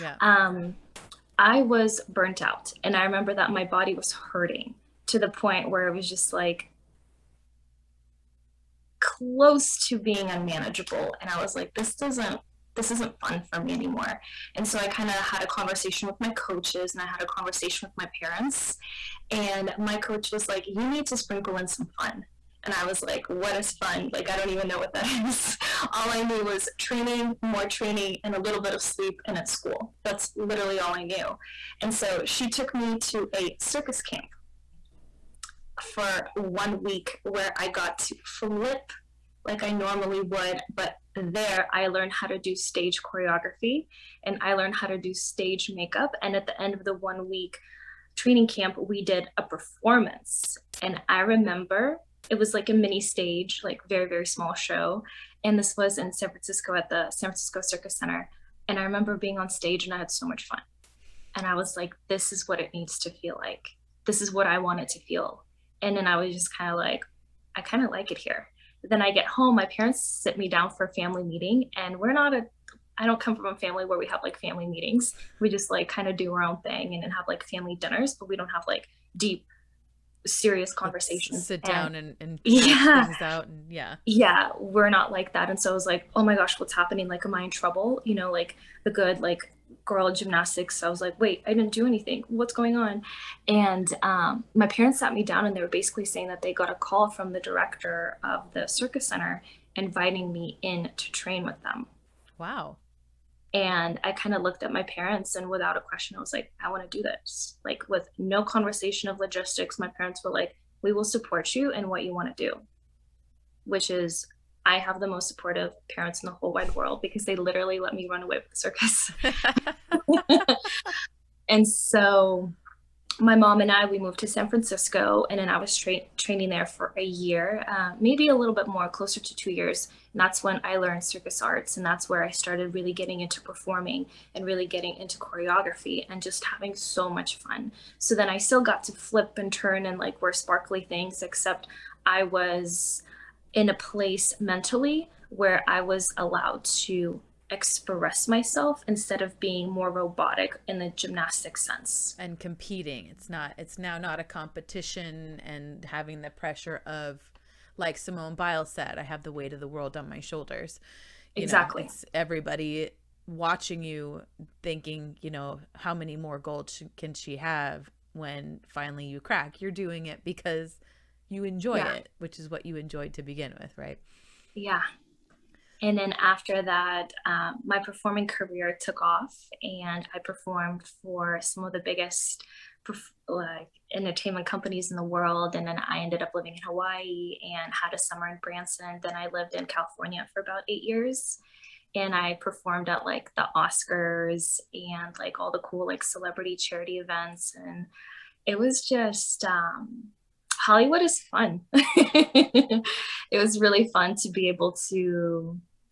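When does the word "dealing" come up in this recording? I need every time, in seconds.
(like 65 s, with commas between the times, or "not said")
not said.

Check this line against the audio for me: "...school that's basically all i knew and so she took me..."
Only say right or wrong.
wrong.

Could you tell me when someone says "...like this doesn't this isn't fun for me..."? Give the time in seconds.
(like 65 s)
11 s.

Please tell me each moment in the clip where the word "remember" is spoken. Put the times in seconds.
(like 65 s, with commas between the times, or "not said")
3 s, 51 s, 58 s.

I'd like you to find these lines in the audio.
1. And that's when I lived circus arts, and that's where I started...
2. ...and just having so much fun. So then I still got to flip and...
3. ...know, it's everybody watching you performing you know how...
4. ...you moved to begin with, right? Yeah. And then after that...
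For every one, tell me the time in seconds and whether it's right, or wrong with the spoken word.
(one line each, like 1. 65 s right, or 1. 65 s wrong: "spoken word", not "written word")
1. 130 s wrong: "learned", not "lived"
2. 136 s right
3. 161 s wrong: "thinking", not "performing"
4. 172 s wrong: "enjoyed", not "moved".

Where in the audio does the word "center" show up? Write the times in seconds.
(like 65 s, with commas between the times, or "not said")
57 s, 99 s.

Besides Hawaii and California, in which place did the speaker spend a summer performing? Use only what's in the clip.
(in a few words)
Branson.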